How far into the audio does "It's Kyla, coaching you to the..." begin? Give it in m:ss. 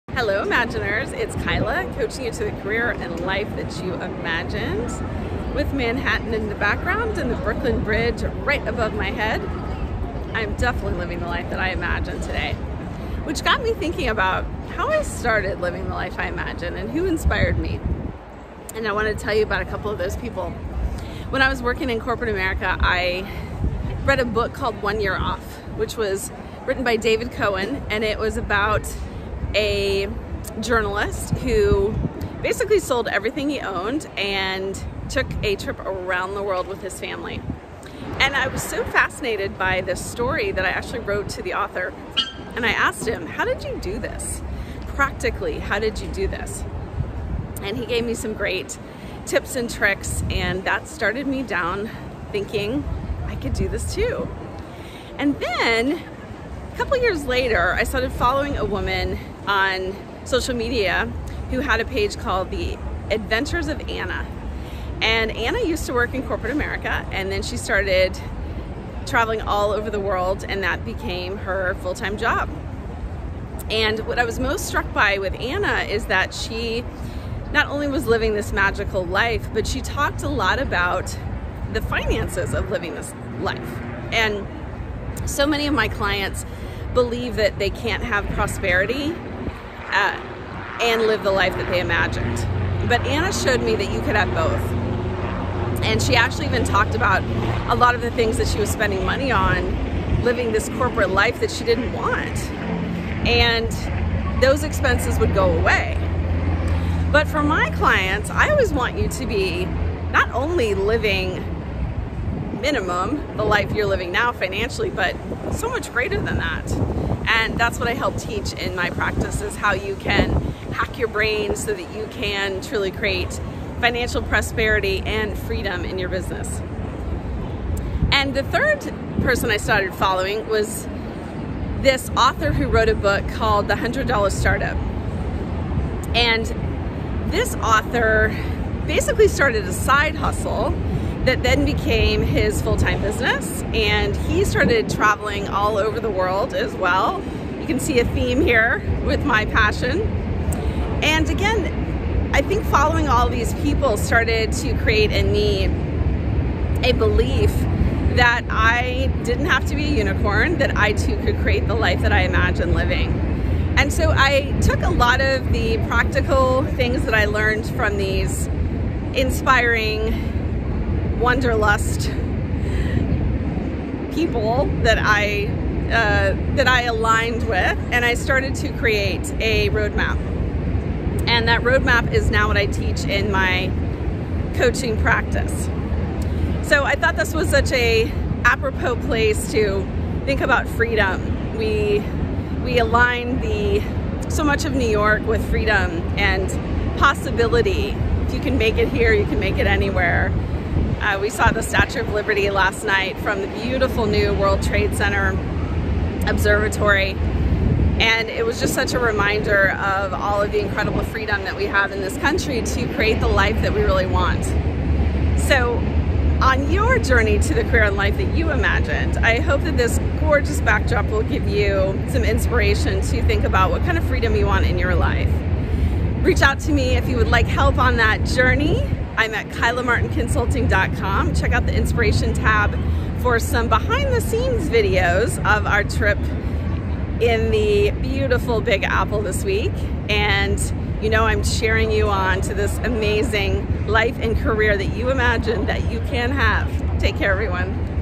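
0:01.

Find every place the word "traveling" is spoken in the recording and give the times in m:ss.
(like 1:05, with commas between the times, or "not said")
1:09, 2:24.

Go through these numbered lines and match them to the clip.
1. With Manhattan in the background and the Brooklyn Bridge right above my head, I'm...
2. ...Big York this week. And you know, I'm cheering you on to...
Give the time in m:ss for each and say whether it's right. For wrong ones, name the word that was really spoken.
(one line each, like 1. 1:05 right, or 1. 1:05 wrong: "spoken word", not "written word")
1. 0:05 right
2. 3:58 wrong: "Apple", not "York".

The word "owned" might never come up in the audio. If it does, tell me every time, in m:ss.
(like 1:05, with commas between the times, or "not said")
0:33.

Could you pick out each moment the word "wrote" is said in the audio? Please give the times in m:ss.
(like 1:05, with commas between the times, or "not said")
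0:40, 2:12.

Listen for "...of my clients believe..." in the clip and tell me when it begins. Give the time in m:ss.
1:25.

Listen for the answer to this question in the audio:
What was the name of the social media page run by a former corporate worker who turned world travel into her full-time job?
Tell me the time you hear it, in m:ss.
1:02.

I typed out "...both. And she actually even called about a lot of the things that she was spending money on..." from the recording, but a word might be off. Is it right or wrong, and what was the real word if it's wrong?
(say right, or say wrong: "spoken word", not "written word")
wrong: "talked", not "called".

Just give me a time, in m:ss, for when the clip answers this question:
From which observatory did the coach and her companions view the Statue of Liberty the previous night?
3:24.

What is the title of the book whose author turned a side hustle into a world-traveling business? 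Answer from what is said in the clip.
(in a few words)
The $100 Startup.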